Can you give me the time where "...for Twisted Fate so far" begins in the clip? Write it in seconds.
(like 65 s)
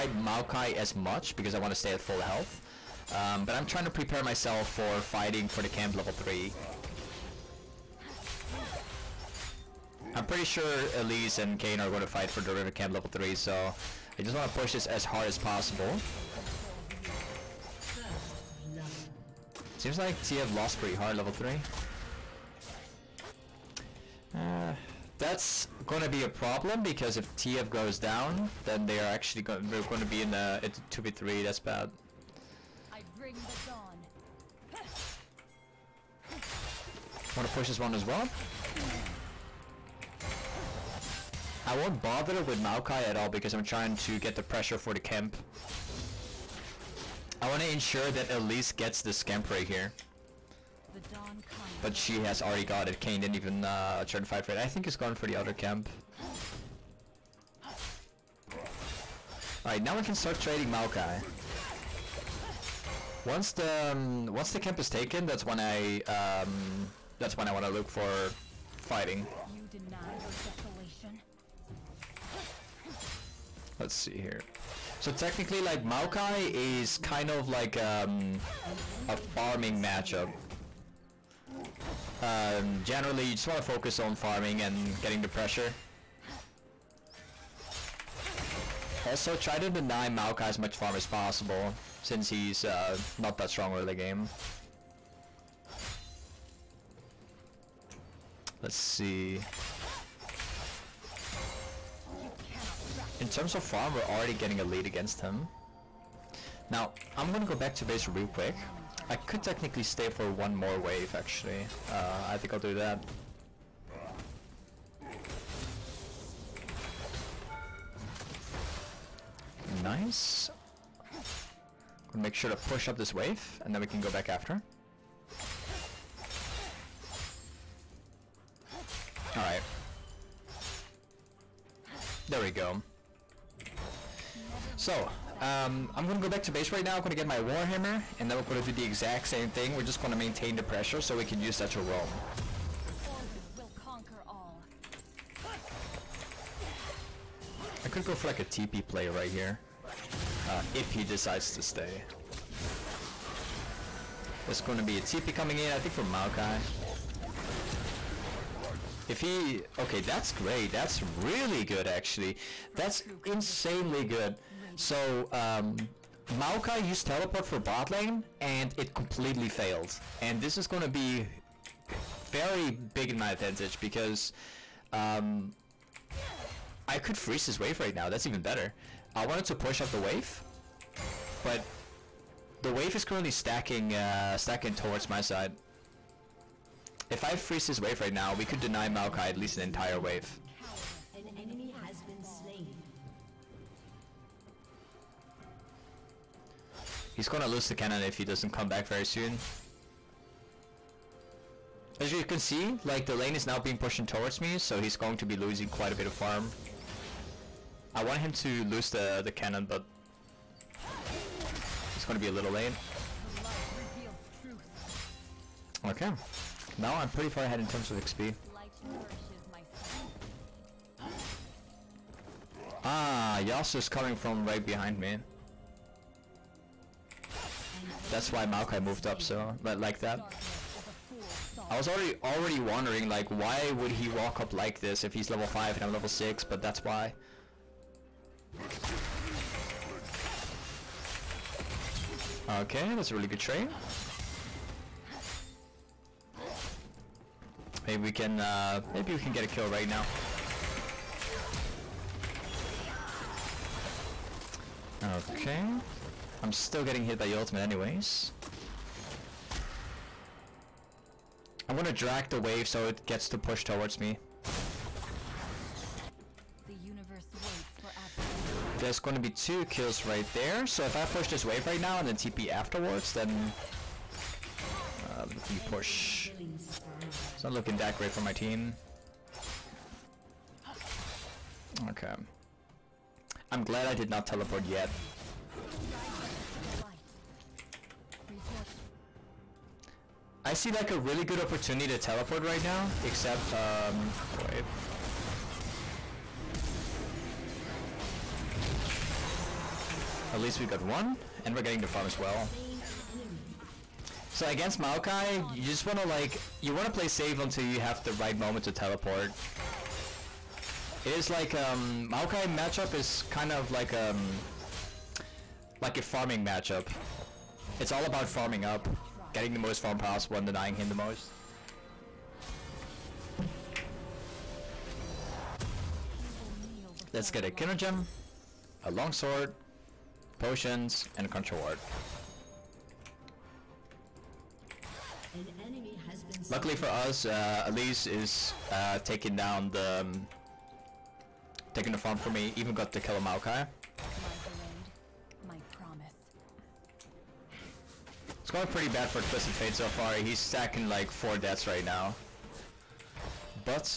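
349 s.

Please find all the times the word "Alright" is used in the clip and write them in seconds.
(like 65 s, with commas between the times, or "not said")
59 s, 129 s.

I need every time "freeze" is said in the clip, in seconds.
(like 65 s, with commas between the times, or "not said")
177 s, 187 s.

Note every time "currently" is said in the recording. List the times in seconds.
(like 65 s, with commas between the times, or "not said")
183 s.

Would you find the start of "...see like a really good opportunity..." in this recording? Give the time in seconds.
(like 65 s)
290 s.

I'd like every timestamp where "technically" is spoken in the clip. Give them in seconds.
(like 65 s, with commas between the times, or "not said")
75 s, 109 s.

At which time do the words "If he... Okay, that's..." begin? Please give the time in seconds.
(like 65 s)
159 s.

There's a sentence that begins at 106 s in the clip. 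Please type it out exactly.
Now, I'm gonna go back to base real quick.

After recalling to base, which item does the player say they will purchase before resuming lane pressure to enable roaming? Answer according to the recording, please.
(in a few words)
Warhammer.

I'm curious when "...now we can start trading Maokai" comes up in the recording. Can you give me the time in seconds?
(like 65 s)
59 s.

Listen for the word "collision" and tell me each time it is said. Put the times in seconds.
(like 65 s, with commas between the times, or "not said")
not said.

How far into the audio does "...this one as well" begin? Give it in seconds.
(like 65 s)
37 s.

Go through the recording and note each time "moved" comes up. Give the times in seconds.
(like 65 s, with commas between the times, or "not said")
228 s.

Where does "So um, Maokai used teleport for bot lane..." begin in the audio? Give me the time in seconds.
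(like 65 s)
164 s.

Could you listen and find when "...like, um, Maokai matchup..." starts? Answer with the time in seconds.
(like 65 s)
311 s.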